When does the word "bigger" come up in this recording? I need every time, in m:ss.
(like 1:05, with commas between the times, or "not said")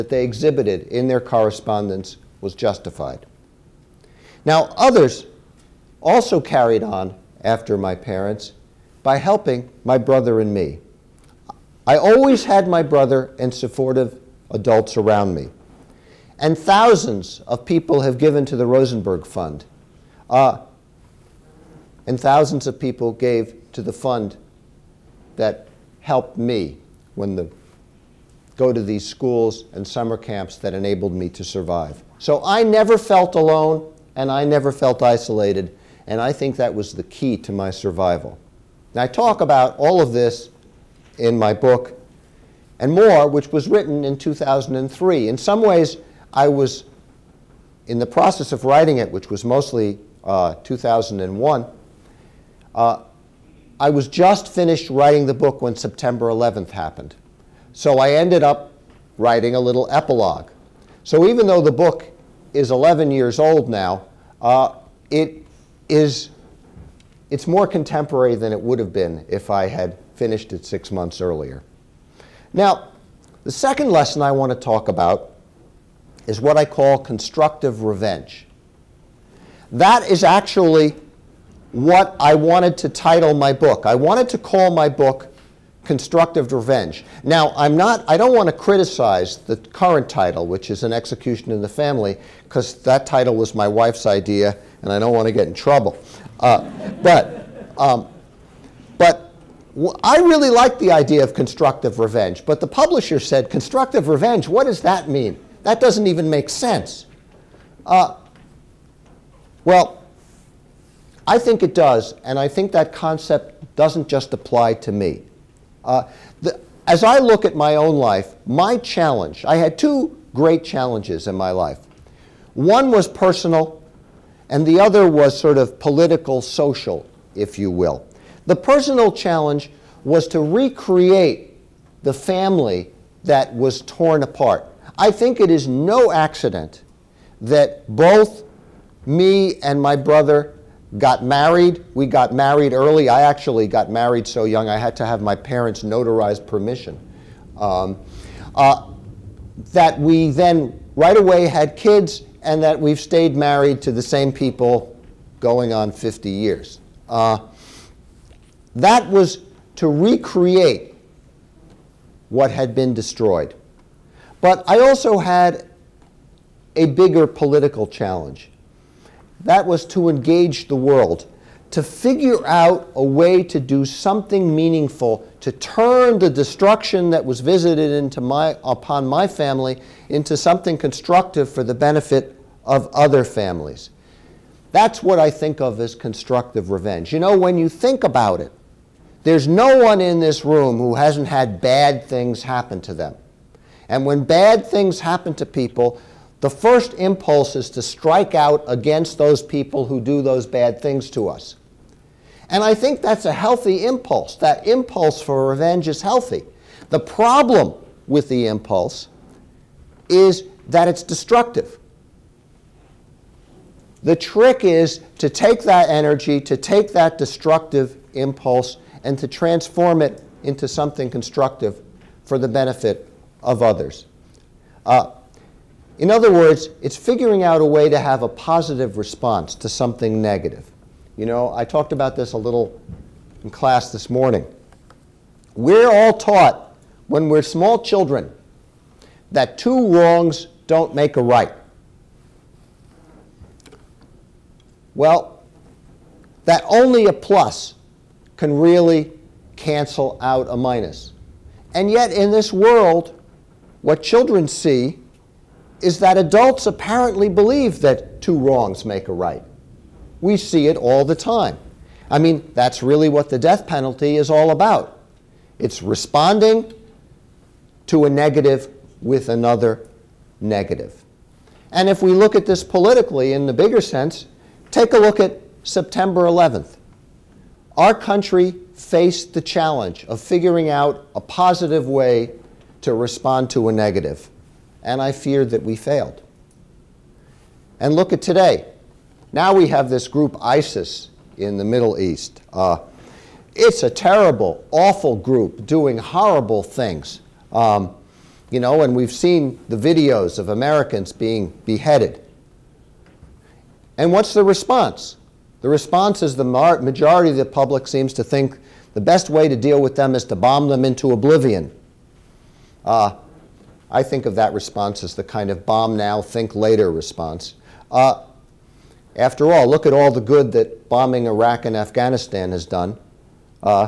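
2:46, 4:33.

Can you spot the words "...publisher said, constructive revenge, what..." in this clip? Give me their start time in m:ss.
1:42.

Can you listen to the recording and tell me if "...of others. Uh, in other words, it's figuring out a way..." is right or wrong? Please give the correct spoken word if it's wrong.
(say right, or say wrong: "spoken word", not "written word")
right.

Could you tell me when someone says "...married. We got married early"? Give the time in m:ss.
2:21.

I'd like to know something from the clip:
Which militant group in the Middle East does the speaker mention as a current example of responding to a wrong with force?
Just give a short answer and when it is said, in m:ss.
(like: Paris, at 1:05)
ISIS, at 4:50.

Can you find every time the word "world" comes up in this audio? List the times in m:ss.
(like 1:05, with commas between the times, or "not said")
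2:50, 4:12.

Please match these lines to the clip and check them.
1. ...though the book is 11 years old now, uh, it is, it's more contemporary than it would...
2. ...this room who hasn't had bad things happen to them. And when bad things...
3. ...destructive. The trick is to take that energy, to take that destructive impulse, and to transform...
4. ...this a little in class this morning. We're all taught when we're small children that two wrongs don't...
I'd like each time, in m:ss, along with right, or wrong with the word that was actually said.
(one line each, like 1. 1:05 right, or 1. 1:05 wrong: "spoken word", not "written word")
1. 1:01 right
2. 3:10 right
3. 3:31 right
4. 3:52 right.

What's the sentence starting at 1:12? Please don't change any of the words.
Now, the second lesson I want to talk about is what I call constructive revenge.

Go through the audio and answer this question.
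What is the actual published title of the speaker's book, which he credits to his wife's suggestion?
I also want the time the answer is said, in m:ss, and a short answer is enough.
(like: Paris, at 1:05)
An Execution in the Family, at 1:30.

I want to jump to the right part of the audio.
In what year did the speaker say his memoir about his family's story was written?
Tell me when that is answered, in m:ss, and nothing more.
0:44.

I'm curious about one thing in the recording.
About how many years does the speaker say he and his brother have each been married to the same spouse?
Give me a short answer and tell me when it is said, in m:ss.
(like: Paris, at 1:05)
50 years, at 2:35.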